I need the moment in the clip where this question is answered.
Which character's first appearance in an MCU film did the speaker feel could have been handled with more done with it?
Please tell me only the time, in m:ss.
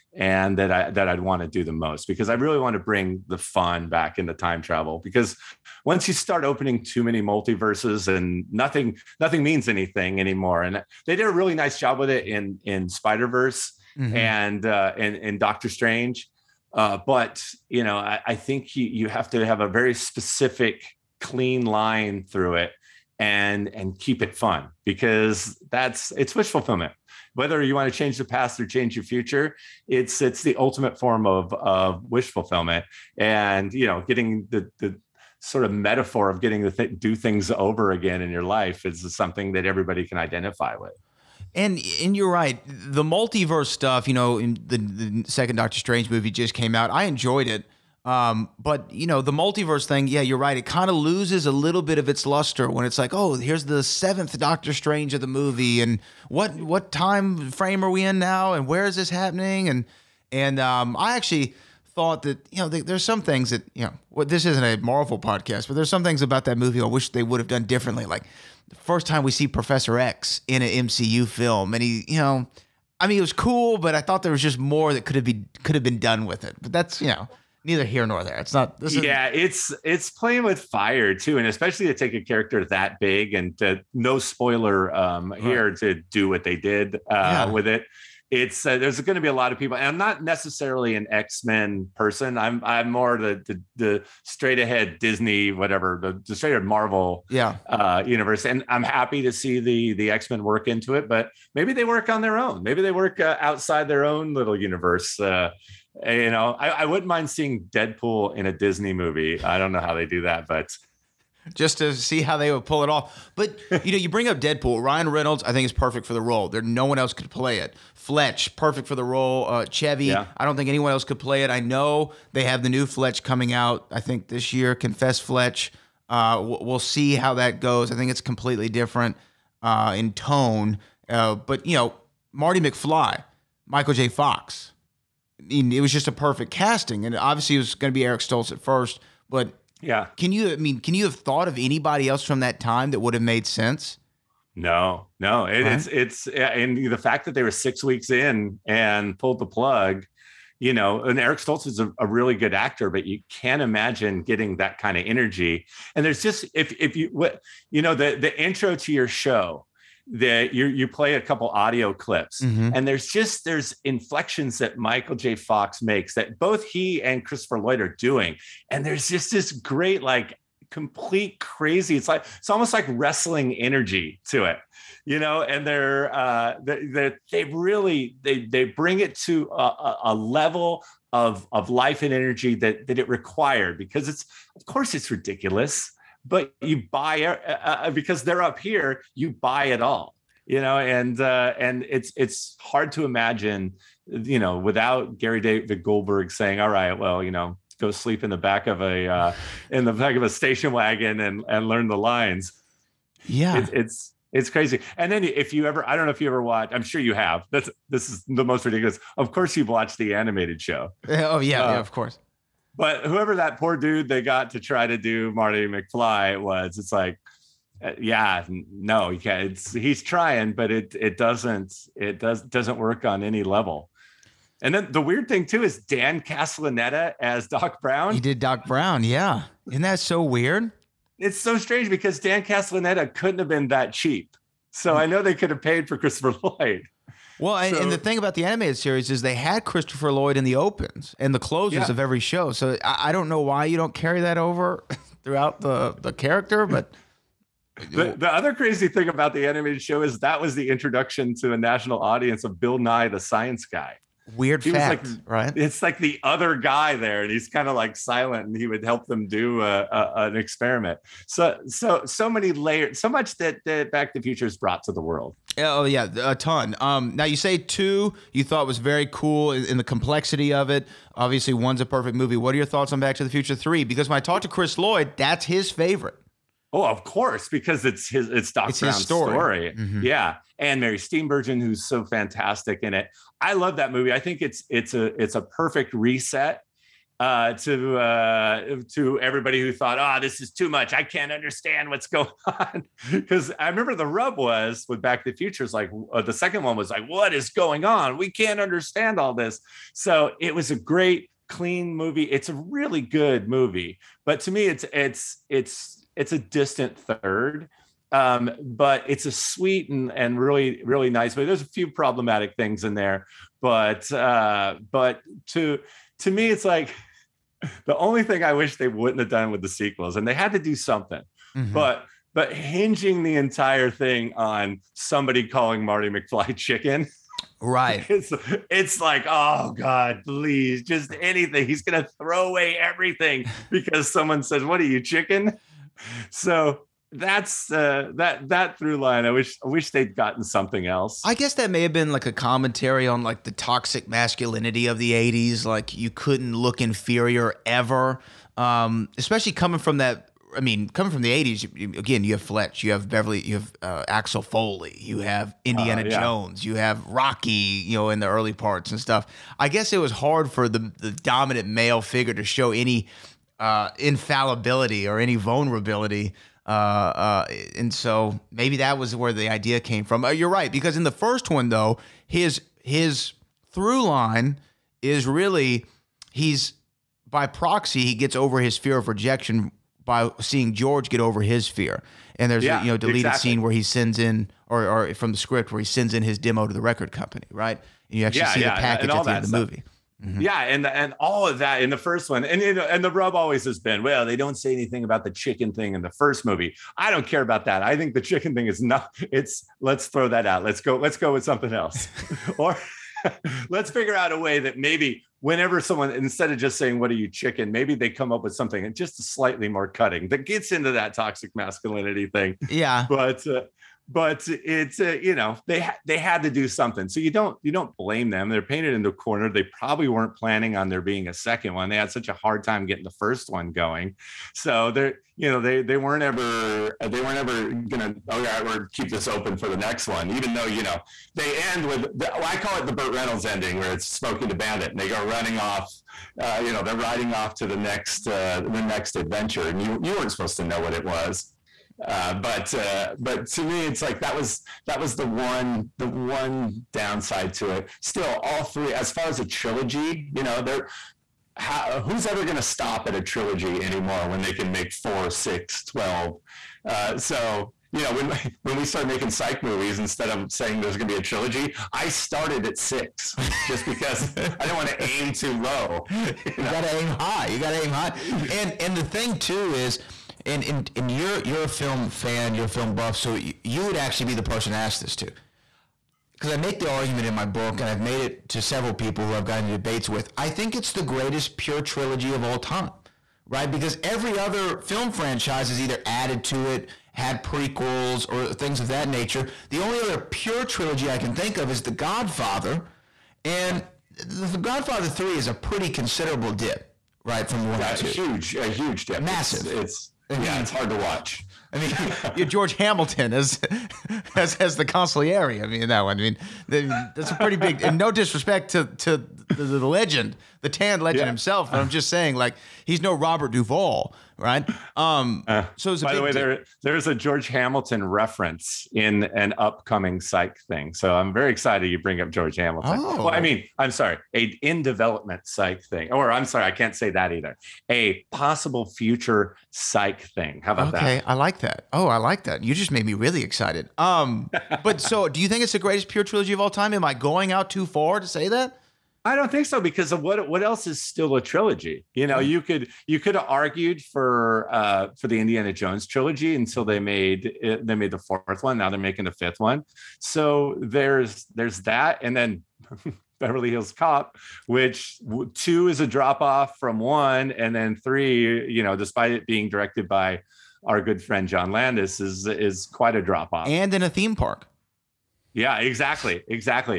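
1:09.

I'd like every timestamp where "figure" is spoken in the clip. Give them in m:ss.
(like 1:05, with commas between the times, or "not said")
6:02, 6:43.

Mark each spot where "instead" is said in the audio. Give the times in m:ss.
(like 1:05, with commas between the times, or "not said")
6:46, 7:40.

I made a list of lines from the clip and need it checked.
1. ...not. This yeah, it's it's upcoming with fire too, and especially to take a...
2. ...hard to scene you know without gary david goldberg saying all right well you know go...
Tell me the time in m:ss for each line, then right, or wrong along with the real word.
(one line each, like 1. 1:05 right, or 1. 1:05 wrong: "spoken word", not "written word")
1. 1:18 wrong: "playing", not "upcoming"
2. 3:12 wrong: "imagine", not "scene".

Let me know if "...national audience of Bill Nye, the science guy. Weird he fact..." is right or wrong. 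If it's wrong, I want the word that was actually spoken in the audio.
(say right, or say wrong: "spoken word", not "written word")
right.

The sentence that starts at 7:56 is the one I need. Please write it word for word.
Because I make the argument in my book, and I've made it to several people who I've gotten into debates with.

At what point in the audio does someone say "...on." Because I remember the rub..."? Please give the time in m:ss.
4:52.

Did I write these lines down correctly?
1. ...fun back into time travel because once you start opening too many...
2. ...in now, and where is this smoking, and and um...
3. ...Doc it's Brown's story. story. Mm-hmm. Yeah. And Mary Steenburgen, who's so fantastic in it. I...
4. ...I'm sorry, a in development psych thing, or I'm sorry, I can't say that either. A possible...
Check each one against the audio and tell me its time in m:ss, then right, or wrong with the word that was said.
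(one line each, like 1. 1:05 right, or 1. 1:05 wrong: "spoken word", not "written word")
1. 0:03 right
2. 0:58 wrong: "happening", not "smoking"
3. 4:38 right
4. 8:43 right.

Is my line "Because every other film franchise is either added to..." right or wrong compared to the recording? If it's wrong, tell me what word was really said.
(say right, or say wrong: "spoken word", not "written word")
right.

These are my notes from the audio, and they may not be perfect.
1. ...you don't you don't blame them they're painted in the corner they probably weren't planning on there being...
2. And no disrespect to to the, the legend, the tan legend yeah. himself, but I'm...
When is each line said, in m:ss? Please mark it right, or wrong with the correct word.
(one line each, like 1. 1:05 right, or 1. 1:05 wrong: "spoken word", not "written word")
1. 6:57 right
2. 8:27 right.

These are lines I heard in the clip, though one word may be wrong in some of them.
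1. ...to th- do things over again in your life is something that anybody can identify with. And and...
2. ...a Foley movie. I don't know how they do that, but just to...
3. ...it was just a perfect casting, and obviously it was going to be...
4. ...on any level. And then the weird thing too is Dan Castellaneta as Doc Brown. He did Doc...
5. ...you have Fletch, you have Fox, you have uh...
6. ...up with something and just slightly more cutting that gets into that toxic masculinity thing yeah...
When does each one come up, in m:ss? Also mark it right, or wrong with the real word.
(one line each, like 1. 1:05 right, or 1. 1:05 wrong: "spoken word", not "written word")
1. 0:36 wrong: "everybody", not "anybody"
2. 1:48 wrong: "Disney", not "Foley"
3. 2:15 right
4. 3:43 right
5. 5:52 wrong: "Beverly", not "Fox"
6. 6:48 right.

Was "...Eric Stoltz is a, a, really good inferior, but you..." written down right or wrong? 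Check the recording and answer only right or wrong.
wrong.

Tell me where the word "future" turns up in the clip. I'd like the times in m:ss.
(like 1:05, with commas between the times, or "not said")
0:29, 4:24, 4:33, 4:55, 8:48.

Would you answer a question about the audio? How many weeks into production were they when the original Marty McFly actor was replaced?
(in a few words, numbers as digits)
6.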